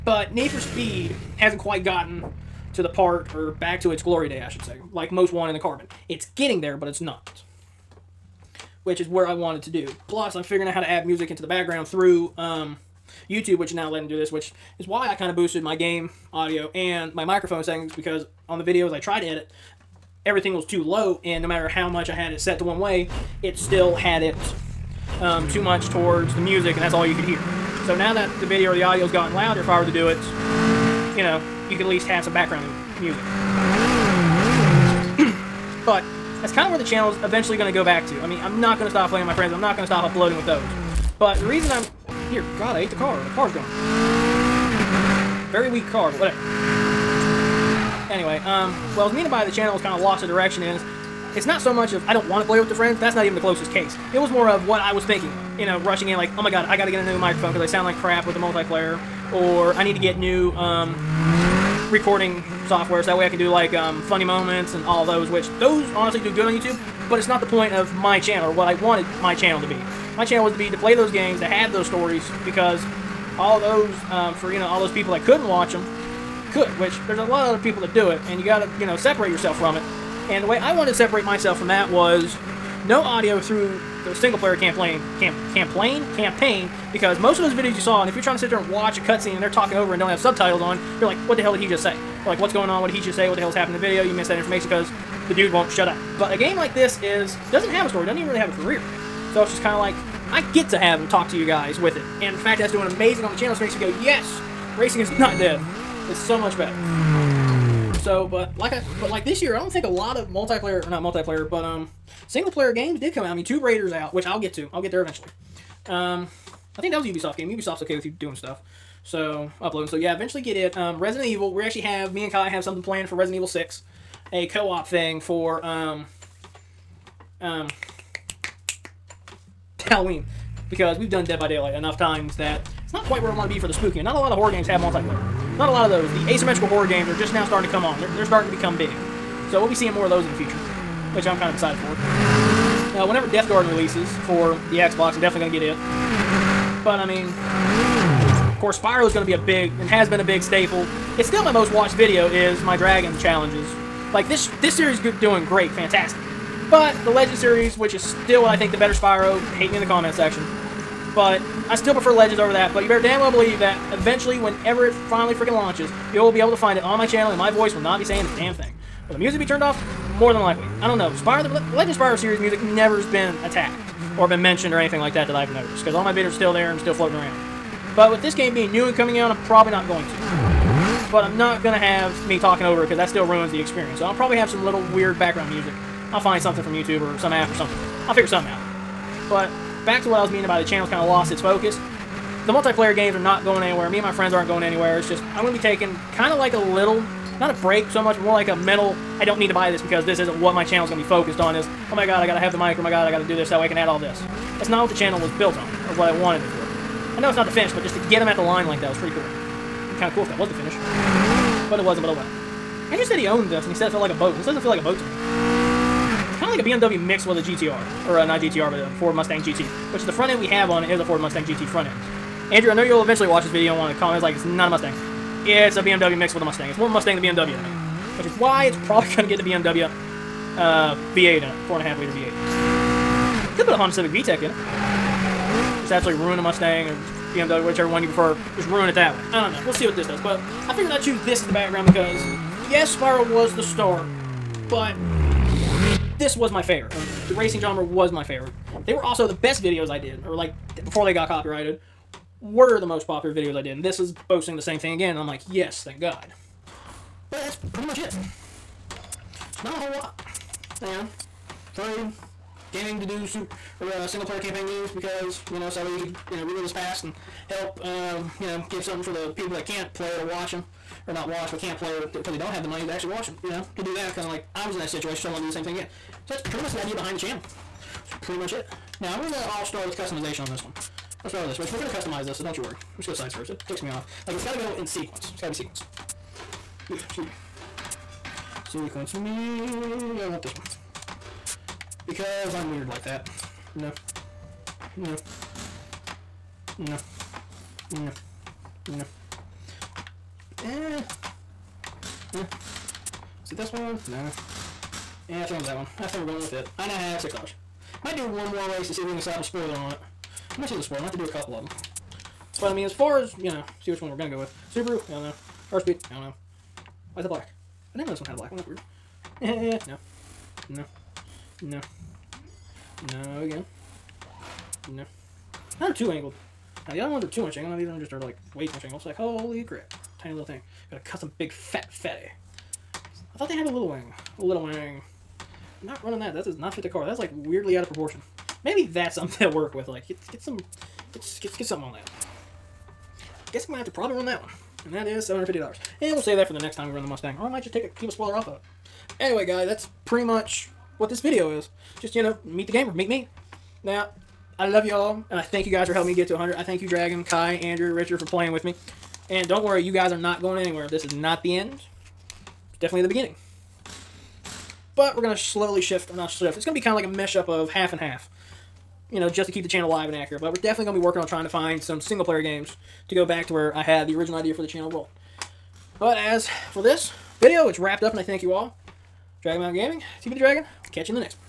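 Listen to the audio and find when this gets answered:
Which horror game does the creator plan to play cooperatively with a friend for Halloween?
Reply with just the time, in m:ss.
2:03.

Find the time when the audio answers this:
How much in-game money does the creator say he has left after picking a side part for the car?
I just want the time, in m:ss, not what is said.
5:07.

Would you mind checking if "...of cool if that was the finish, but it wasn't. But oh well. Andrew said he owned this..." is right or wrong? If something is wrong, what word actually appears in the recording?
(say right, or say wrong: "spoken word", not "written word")
right.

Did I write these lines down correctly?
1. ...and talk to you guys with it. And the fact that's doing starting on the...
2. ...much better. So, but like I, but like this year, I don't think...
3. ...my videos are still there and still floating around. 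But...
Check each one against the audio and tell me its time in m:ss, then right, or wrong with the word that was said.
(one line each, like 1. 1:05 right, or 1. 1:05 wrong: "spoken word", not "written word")
1. 1:40 wrong: "amazing", not "starting"
2. 1:46 right
3. 2:56 right.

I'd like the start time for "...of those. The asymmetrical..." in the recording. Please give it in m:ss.
2:15.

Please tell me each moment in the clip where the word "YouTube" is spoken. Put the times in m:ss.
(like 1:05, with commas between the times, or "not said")
0:13, 1:06, 3:06.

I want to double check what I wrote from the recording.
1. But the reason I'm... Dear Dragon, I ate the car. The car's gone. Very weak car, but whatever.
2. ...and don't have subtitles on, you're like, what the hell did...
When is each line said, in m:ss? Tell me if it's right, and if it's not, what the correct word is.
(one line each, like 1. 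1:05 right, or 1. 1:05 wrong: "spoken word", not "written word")
1. 0:41 wrong: "God", not "Dragon"
2. 1:29 right.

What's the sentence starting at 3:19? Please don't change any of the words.
I don't need to buy this because this isn't what my channel is going to be focused on.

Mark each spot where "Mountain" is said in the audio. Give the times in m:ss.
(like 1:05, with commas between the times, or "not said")
6:19.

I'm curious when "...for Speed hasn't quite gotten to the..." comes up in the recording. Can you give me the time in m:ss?
0:00.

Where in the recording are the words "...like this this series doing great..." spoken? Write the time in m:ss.
2:34.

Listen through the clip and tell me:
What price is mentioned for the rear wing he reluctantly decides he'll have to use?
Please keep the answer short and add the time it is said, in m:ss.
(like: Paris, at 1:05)
$750, at 5:45.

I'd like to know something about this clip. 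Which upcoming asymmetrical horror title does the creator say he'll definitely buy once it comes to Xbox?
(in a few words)
Deathgarden.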